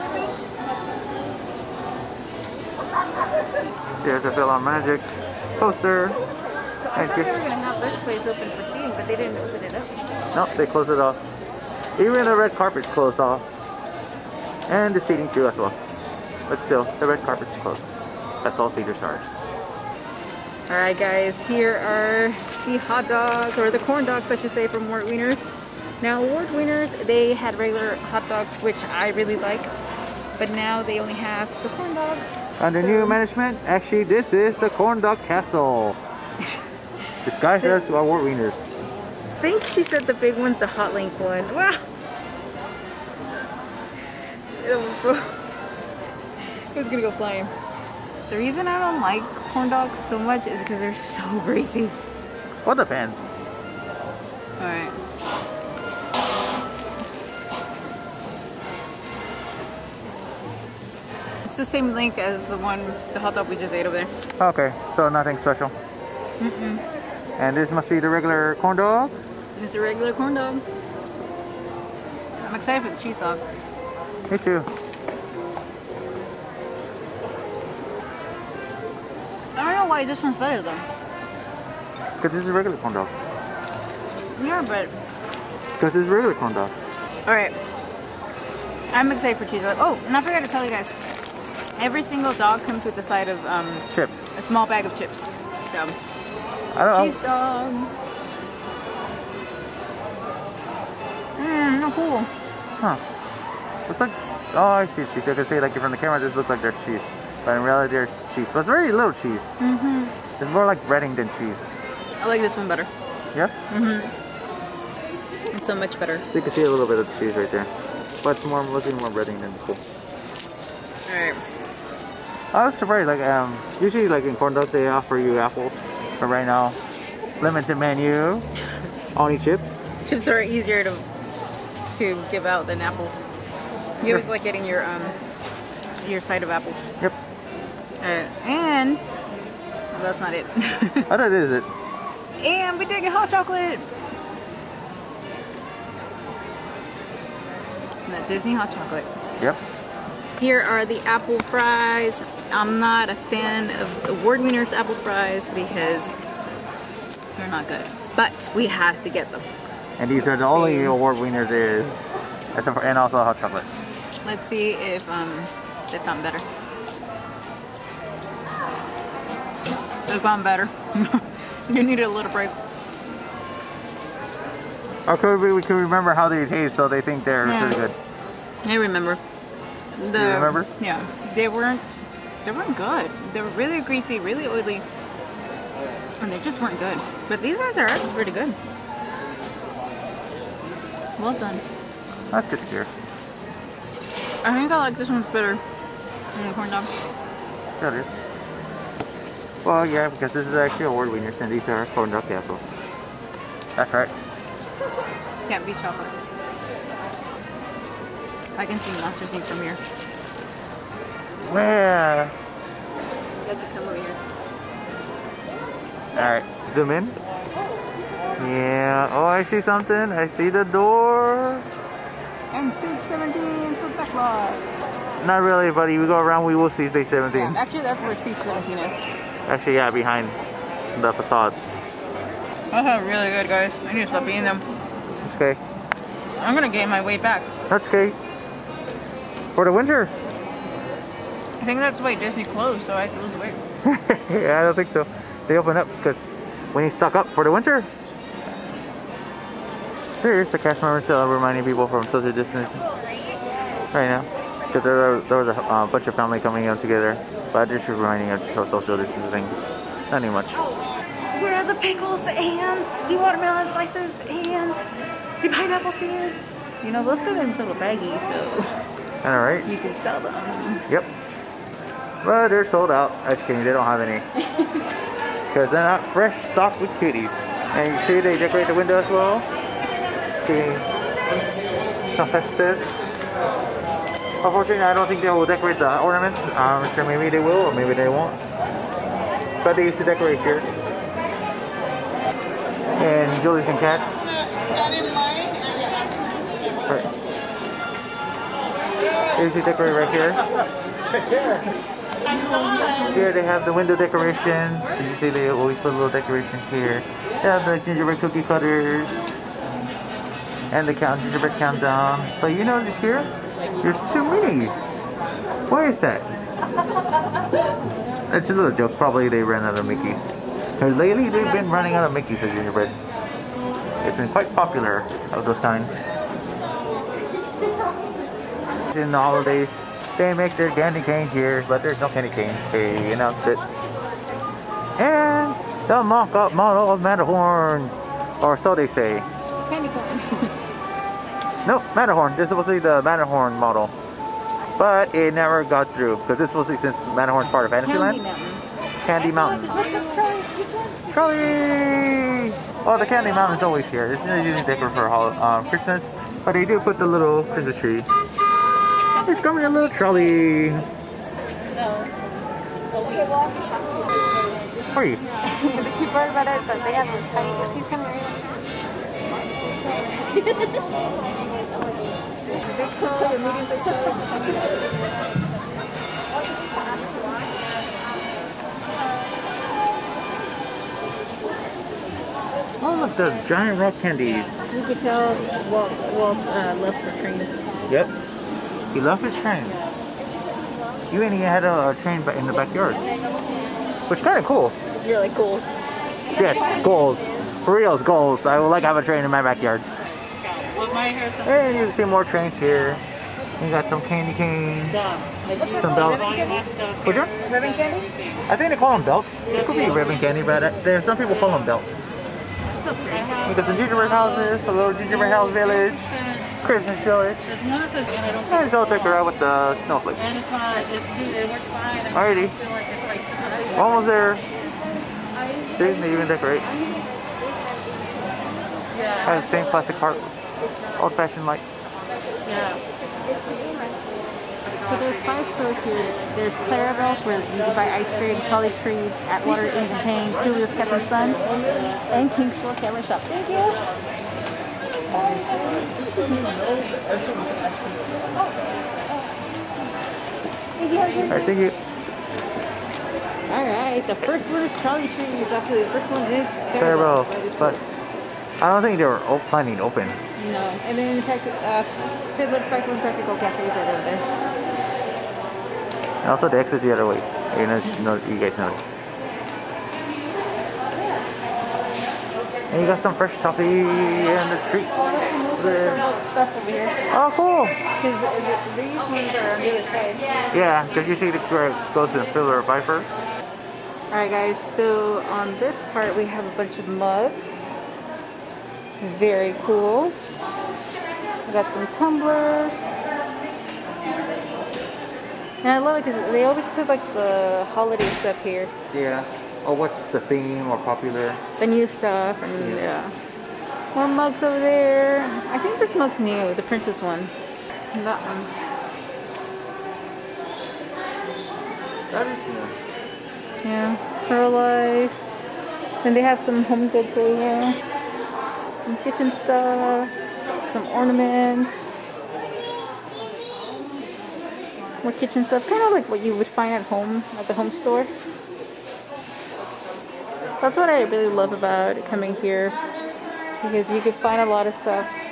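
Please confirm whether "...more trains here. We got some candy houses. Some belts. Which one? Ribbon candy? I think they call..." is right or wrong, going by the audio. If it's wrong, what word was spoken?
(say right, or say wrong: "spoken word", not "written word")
wrong: "canes", not "houses".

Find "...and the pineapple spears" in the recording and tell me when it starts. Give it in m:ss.
4:24.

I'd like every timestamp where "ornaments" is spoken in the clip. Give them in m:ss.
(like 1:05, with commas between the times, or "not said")
4:46, 8:40.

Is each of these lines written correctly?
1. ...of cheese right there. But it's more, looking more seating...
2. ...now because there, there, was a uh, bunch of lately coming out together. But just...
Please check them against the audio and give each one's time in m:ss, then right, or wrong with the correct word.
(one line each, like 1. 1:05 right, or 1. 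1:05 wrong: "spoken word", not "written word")
1. 1:56 wrong: "breading", not "seating"
2. 4:14 wrong: "family", not "lately".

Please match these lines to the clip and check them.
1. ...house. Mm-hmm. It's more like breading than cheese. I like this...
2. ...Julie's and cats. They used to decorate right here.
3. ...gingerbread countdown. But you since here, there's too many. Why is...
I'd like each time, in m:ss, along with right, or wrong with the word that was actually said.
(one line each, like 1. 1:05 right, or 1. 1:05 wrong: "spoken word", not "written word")
1. 1:49 wrong: "cheese", not "house"
2. 4:53 right
3. 5:11 wrong: "notice", not "since".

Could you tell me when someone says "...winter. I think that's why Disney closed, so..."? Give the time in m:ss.
3:59.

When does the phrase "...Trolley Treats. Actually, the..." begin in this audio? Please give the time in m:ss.
7:34.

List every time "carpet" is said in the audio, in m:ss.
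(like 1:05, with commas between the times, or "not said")
0:12, 0:17.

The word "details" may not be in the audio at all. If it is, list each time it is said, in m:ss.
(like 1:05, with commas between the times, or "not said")
not said.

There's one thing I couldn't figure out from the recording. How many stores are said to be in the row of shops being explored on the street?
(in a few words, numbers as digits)
5.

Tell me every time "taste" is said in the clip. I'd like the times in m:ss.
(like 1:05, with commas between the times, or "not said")
2:56.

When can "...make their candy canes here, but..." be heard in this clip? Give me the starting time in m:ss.
5:30.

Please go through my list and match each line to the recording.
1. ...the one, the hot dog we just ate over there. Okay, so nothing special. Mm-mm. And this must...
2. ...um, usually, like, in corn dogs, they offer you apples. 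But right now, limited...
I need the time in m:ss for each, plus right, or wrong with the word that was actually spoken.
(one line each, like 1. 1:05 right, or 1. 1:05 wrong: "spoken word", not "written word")
1. 1:02 right
2. 2:03 right.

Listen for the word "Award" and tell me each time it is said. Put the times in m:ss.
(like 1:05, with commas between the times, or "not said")
2:34, 2:40, 3:20.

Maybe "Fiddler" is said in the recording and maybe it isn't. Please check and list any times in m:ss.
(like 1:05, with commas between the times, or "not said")
7:42, 8:02.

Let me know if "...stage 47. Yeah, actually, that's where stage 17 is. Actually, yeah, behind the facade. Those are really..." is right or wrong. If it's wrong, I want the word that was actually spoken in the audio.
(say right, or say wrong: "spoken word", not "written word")
wrong: "17", not "47".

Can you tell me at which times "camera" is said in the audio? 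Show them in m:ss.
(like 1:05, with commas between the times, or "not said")
1:45, 7:22.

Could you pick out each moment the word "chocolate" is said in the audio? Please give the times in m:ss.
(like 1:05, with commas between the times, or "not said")
2:23, 2:28, 2:43, 3:25.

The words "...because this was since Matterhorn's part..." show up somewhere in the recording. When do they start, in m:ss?
5:46.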